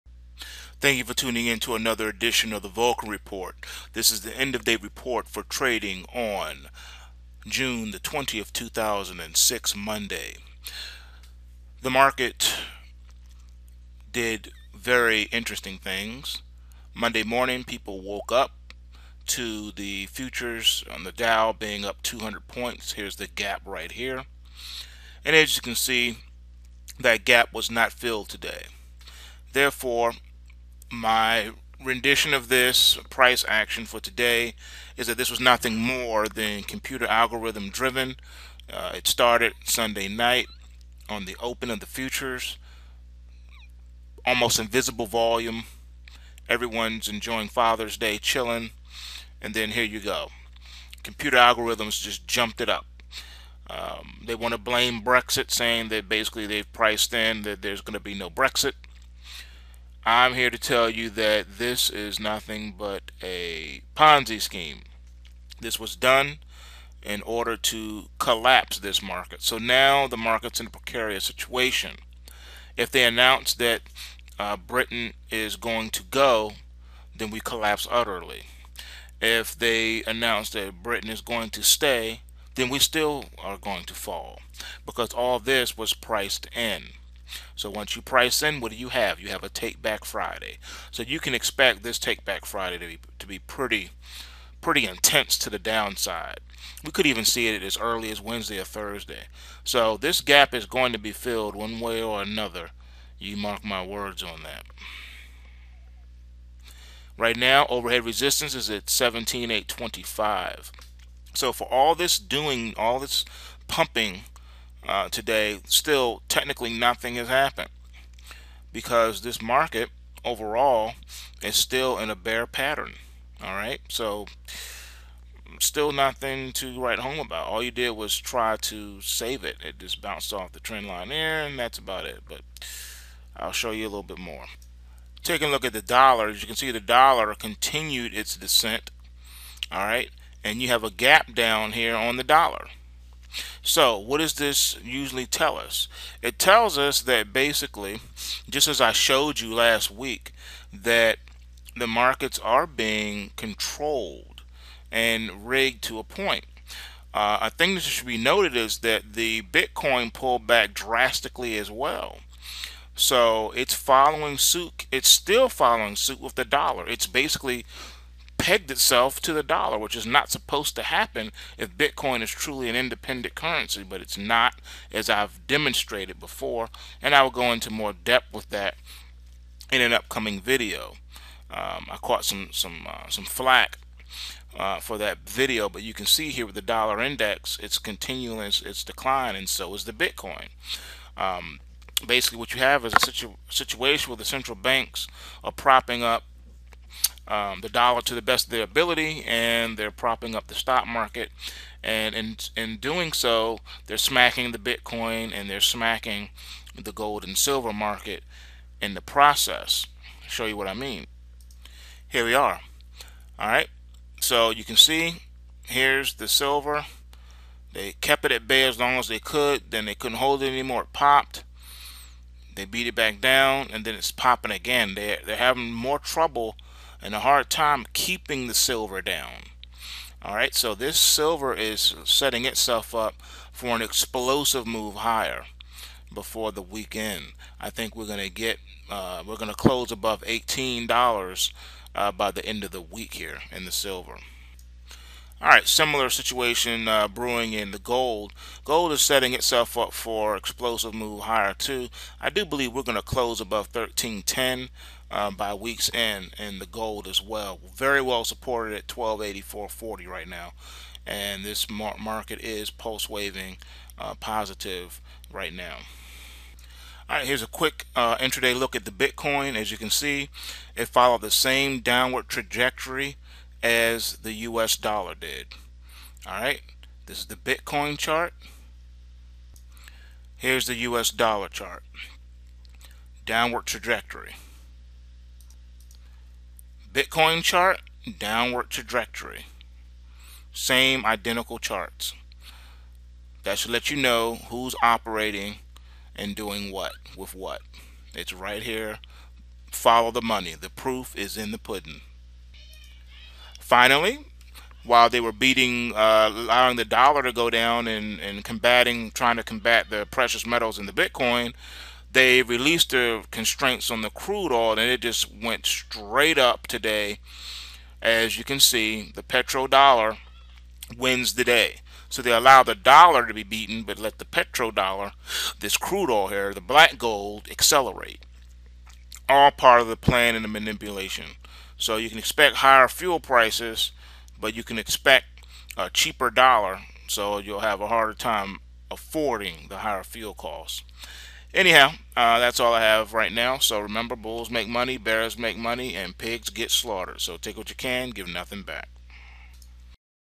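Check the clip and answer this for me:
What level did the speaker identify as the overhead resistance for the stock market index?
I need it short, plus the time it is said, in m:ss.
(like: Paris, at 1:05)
17,825, at 1:48.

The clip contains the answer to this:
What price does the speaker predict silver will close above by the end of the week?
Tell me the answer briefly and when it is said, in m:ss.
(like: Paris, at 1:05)
$18, at 4:00.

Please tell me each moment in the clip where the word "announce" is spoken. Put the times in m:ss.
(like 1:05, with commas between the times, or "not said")
1:13, 1:20.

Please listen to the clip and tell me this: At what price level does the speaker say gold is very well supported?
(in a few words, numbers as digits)
1284.40.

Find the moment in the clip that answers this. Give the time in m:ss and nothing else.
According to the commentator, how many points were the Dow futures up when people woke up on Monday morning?
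0:22.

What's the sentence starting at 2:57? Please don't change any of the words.
And I will go into more depth with that in an upcoming video.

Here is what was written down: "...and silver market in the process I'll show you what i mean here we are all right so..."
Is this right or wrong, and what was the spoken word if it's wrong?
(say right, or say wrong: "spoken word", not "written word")
right.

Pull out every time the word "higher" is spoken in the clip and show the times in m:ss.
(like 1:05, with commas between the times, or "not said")
3:54, 4:11, 5:32, 5:39.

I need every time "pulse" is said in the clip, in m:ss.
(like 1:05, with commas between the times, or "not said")
4:22.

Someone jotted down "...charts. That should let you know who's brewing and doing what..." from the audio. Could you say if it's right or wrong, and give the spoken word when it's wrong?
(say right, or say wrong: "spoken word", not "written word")
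wrong: "operating", not "brewing".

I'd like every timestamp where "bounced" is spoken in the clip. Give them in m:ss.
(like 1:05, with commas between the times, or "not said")
2:10.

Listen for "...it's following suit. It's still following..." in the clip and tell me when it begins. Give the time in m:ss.
2:43.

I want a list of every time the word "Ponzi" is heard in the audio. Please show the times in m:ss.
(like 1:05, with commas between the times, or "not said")
1:03.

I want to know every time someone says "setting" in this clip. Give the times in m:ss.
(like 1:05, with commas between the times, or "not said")
3:52, 4:09.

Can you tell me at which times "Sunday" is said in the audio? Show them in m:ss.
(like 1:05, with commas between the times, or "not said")
0:39.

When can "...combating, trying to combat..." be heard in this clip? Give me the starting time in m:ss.
5:08.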